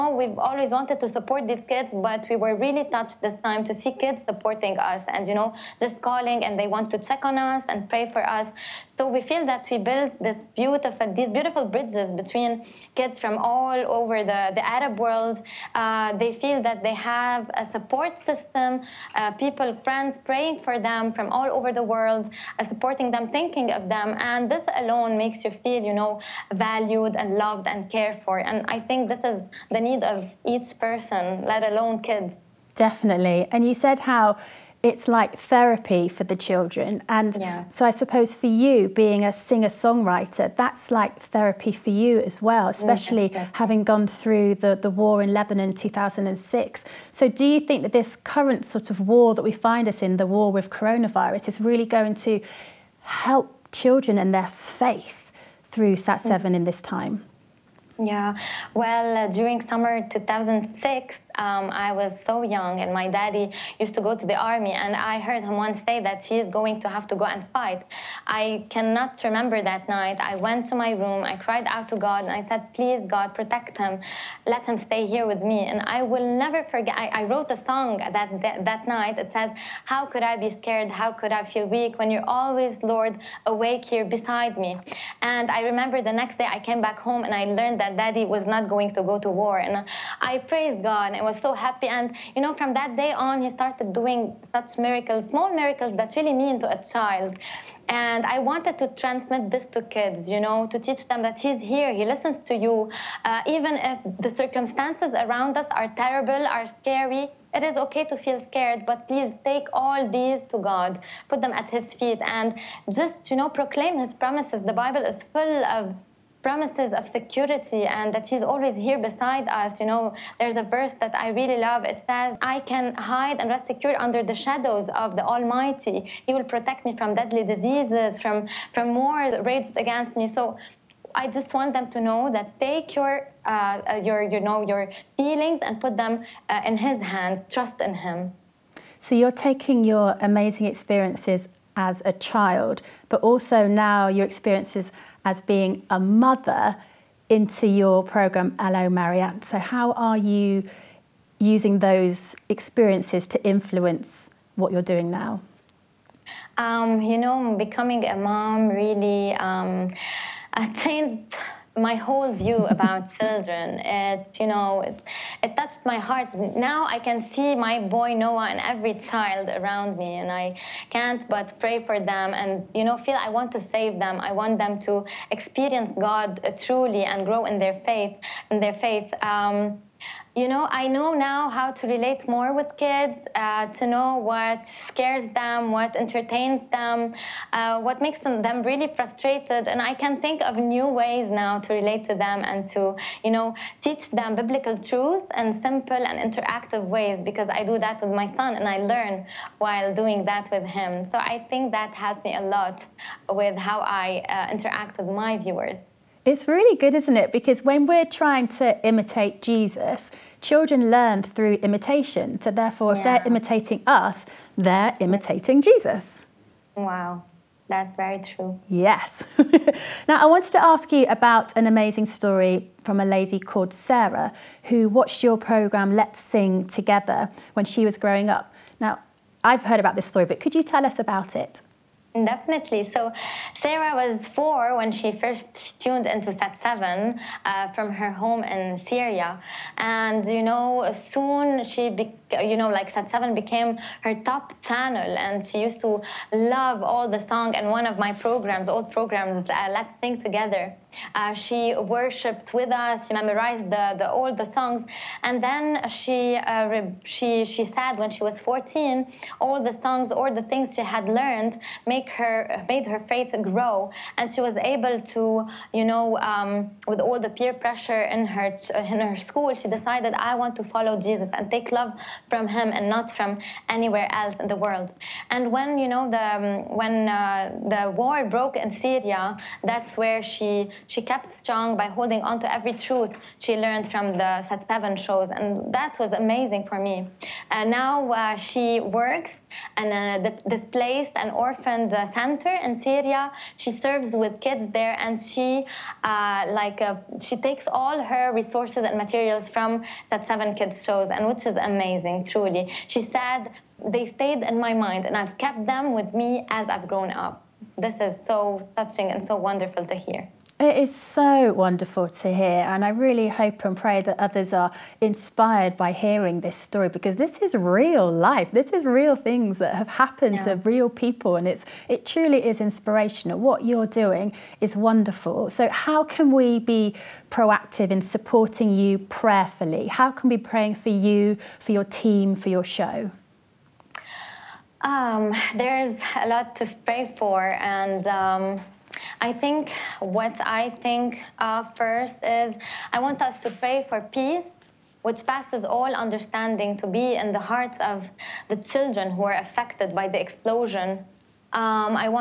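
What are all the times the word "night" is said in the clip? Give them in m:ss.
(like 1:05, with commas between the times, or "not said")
1:09, 1:18.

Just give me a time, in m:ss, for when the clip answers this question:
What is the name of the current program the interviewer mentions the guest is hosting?
2:28.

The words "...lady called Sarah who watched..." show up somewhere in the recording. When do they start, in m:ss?
3:43.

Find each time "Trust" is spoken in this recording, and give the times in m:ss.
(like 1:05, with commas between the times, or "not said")
2:17.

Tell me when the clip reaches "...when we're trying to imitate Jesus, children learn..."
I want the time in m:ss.
3:27.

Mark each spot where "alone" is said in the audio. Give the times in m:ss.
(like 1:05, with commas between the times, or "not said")
0:24, 0:31.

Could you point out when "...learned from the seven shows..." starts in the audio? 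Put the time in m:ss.
4:43.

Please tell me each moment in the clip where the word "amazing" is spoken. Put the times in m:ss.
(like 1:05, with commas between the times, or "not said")
2:20, 3:41, 4:46, 5:01.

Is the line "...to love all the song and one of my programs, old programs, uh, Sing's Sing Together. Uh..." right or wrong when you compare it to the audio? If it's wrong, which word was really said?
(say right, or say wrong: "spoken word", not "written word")
wrong: "Let", not "Sing".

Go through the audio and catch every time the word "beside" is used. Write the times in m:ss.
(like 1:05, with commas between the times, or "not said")
1:24, 1:58.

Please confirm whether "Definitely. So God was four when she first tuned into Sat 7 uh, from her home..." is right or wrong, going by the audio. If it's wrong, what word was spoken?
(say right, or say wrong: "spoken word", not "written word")
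wrong: "Sarah", not "God".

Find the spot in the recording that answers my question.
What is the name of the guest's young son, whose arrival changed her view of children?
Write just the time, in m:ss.
2:48.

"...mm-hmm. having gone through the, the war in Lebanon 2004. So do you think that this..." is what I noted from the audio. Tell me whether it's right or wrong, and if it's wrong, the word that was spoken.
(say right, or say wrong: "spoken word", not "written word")
wrong: "2006", not "2004".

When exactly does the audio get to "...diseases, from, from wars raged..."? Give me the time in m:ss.
2:07.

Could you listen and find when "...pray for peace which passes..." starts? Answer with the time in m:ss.
5:43.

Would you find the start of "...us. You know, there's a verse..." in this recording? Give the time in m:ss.
1:59.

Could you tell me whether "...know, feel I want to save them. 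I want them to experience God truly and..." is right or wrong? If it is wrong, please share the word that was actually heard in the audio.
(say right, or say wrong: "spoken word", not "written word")
right.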